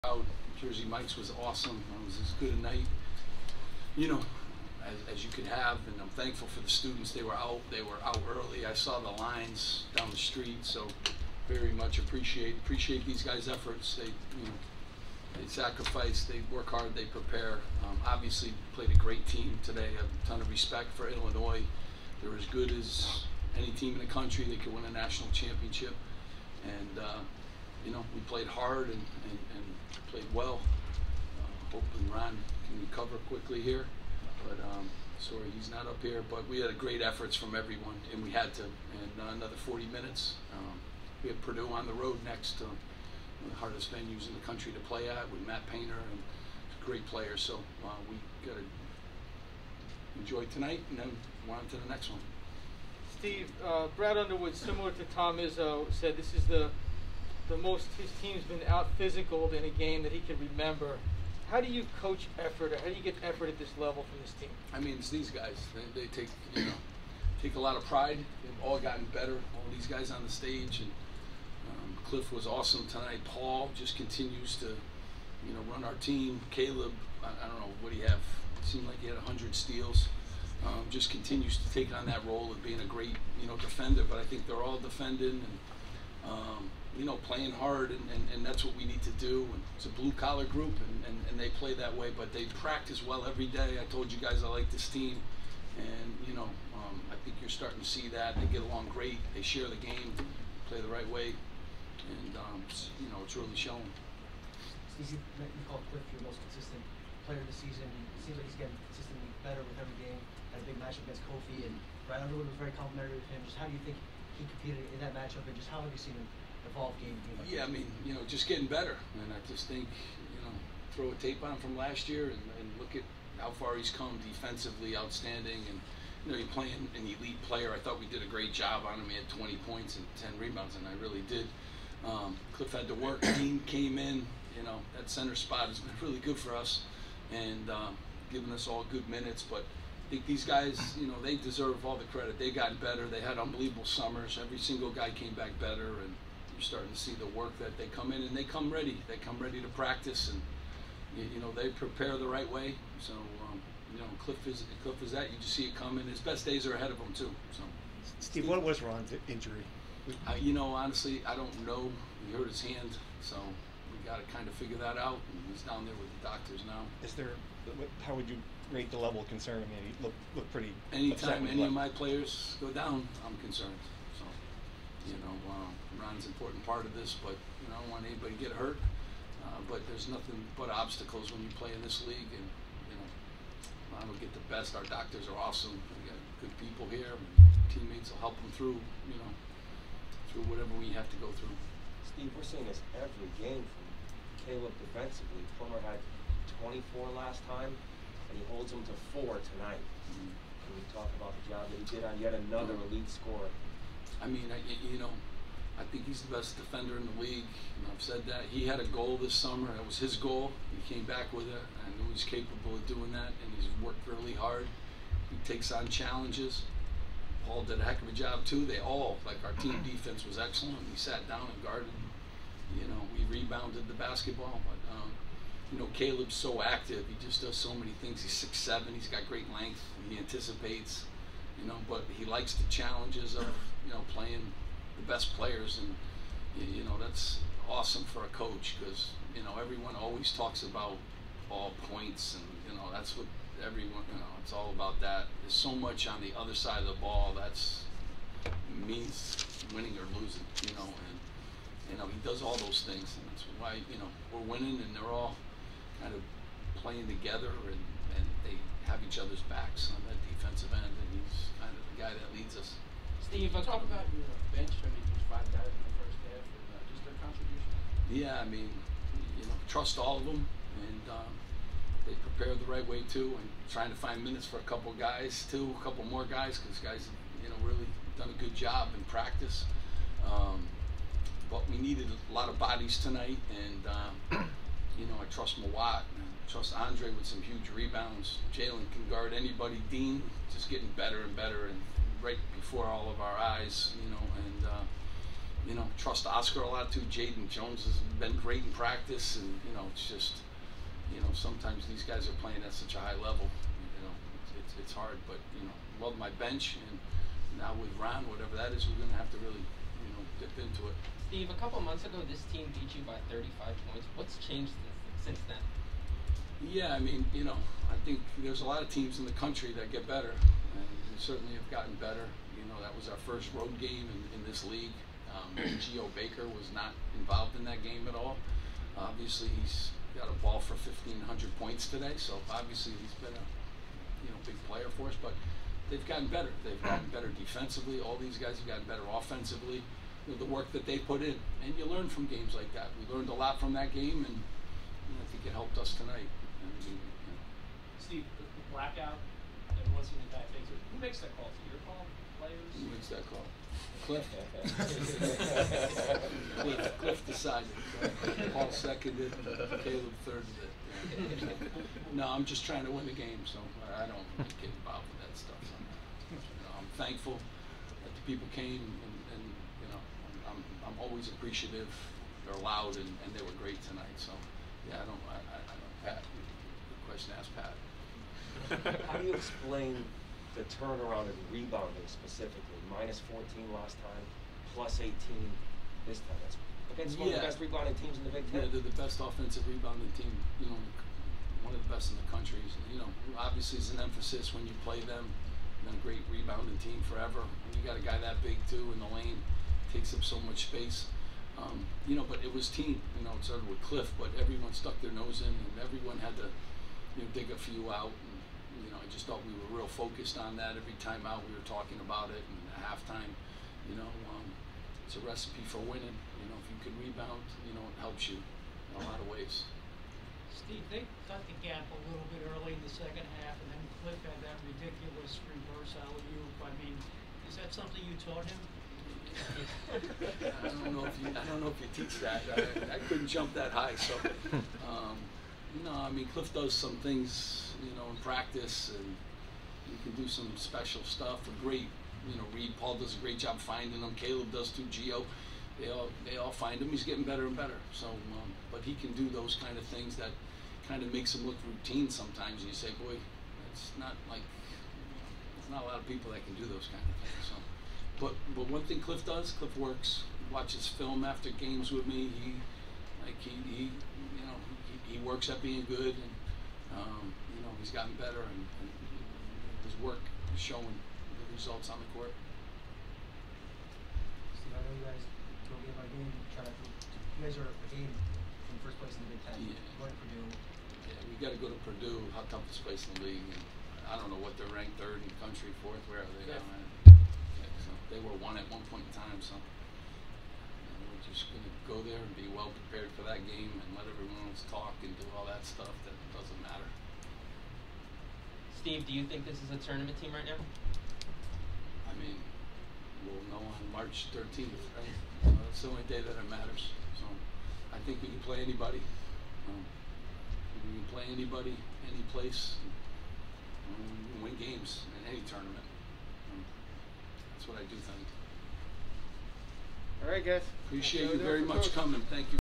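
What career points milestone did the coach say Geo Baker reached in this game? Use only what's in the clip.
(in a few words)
1,500 points.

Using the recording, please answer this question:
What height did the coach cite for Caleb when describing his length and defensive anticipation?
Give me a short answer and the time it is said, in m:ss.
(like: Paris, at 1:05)
6'7", at 3:48.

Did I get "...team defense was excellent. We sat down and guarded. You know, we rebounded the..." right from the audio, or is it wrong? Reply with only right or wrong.
right.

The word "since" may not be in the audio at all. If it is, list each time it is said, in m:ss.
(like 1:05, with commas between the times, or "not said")
5:15.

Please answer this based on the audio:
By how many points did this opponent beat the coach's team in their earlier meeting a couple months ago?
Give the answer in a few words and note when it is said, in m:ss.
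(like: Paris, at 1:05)
35, at 5:13.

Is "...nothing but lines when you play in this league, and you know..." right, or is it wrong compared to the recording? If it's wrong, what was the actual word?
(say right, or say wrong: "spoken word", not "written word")
wrong: "obstacles", not "lines".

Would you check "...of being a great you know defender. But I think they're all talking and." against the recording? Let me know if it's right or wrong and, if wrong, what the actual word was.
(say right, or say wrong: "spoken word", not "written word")
wrong: "defending", not "talking".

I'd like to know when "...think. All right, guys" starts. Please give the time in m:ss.
8:38.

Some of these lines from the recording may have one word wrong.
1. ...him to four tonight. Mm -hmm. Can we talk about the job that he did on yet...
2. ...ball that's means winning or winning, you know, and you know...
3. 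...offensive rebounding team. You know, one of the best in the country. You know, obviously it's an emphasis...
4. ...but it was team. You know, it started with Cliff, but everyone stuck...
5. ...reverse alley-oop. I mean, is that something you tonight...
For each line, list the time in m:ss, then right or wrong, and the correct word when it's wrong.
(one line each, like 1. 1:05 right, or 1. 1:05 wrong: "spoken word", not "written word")
1. 3:18 right
2. 4:07 wrong: "losing", not "winning"
3. 6:29 right
4. 6:42 right
5. 7:05 wrong: "taught", not "tonight".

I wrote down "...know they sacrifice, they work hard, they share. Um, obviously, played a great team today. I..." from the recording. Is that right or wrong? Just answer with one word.
wrong.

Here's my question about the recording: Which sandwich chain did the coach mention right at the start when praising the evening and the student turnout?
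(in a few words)
Jersey Mike's.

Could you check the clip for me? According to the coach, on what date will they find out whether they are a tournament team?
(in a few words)
March 13.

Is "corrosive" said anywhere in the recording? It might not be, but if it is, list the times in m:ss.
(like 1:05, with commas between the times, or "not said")
not said.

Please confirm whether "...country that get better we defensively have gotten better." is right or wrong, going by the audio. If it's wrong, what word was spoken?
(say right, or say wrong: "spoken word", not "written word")
wrong: "certainly", not "defensively".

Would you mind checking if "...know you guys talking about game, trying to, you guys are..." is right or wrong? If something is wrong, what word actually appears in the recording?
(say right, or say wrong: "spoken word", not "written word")
right.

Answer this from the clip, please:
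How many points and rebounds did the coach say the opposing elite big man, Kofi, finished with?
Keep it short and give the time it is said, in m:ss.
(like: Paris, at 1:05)
20 points and 10 rebounds, at 2:09.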